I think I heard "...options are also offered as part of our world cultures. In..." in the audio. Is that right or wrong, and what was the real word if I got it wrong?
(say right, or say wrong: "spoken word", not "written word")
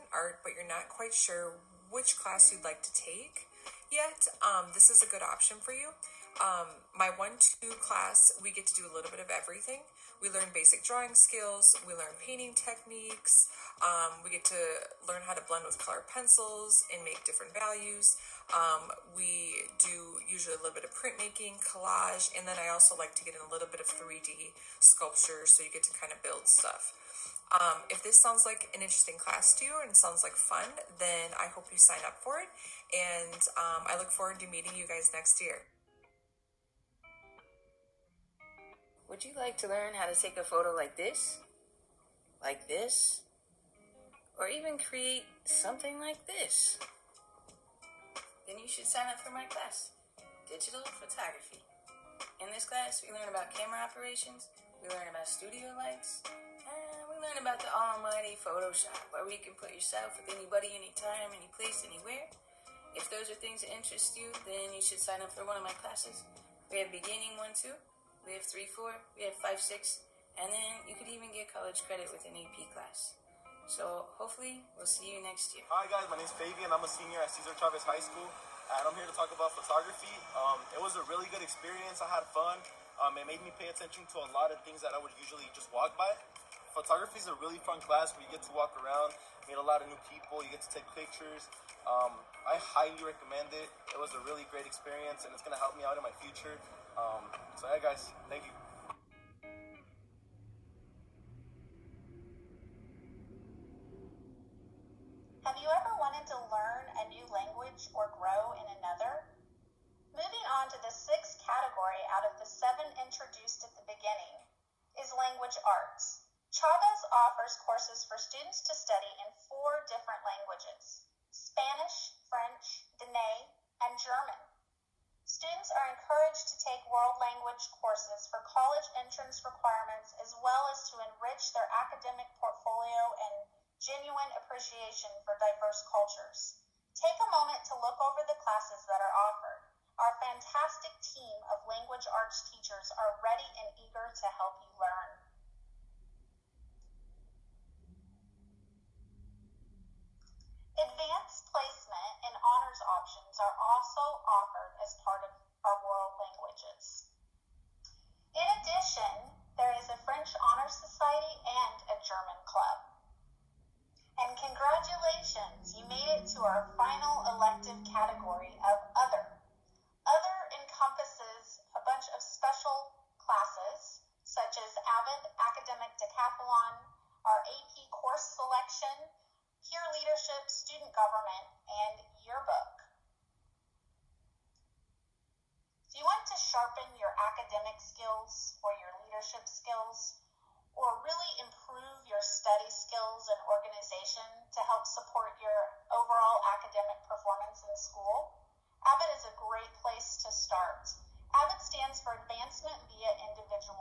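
wrong: "languages", not "cultures".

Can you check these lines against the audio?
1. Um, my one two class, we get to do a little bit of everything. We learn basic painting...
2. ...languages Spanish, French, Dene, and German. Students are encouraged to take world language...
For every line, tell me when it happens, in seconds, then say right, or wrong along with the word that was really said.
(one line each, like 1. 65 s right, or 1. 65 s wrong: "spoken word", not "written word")
1. 6 s wrong: "drawing", not "painting"
2. 120 s right.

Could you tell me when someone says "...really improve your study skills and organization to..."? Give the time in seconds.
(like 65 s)
191 s.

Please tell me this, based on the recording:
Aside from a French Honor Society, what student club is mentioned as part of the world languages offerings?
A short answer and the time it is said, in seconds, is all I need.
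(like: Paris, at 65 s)
German club, at 162 s.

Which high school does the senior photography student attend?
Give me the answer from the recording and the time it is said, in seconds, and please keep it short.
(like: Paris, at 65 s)
Cesar Chavez High School, at 77 s.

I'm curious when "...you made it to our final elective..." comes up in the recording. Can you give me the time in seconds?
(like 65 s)
165 s.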